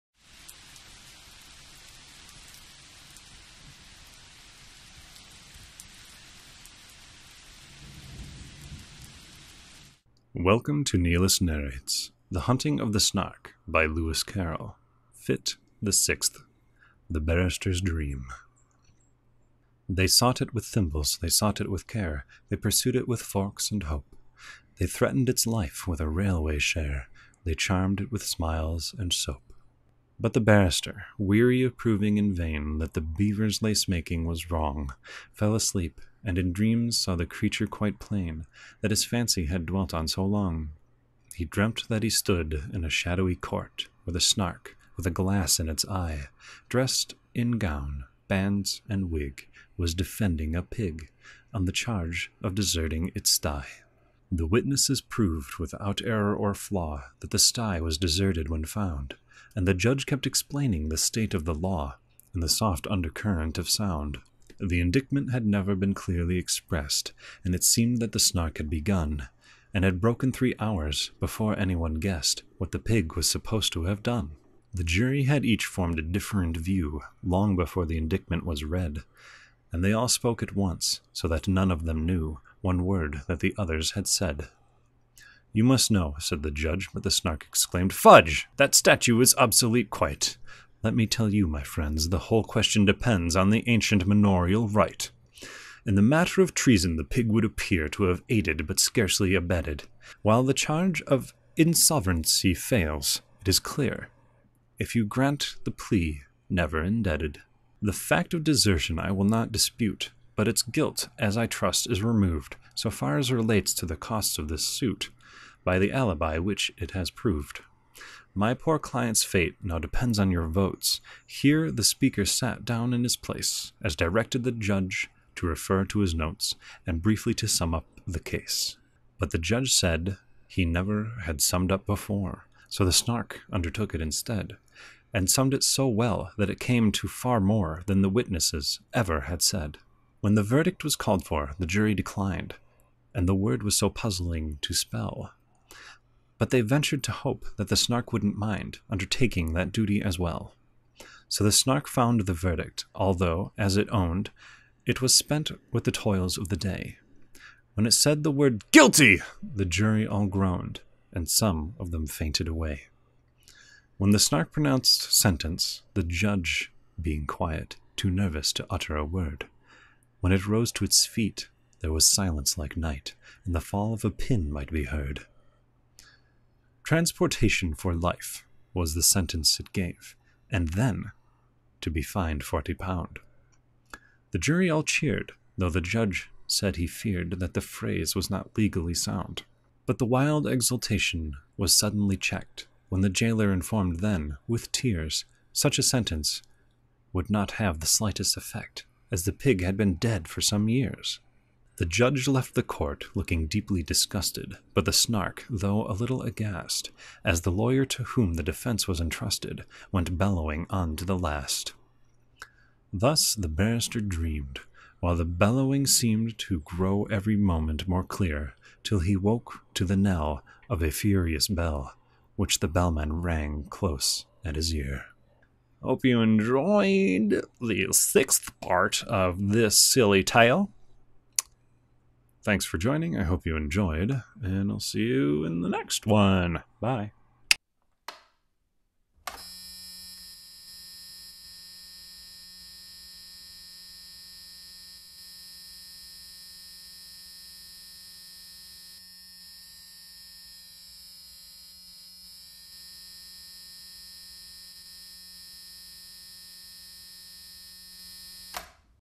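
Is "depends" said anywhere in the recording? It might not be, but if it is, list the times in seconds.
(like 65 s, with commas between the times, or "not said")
92 s, 119 s.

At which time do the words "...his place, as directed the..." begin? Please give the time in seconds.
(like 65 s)
123 s.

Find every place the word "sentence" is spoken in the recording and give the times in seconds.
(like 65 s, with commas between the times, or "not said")
165 s, 179 s, 195 s.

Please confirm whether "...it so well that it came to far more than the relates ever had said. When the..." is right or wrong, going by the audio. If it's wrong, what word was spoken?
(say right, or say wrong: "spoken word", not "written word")
wrong: "witnesses", not "relates".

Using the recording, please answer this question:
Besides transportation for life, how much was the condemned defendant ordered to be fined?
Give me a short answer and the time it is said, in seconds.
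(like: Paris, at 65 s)
40 pounds, at 182 s.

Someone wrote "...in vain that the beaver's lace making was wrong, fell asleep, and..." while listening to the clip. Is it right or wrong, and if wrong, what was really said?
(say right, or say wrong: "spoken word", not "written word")
right.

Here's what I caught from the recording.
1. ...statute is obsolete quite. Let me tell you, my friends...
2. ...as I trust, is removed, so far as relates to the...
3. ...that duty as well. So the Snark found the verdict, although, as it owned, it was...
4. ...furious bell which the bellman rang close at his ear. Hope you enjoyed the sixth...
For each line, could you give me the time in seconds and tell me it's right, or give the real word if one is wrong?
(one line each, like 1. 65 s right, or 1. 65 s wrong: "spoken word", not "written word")
1. 88 s right
2. 111 s right
3. 149 s right
4. 220 s right.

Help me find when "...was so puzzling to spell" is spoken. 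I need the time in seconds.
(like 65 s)
143 s.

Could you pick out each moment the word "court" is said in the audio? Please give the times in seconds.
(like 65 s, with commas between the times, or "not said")
43 s, 202 s.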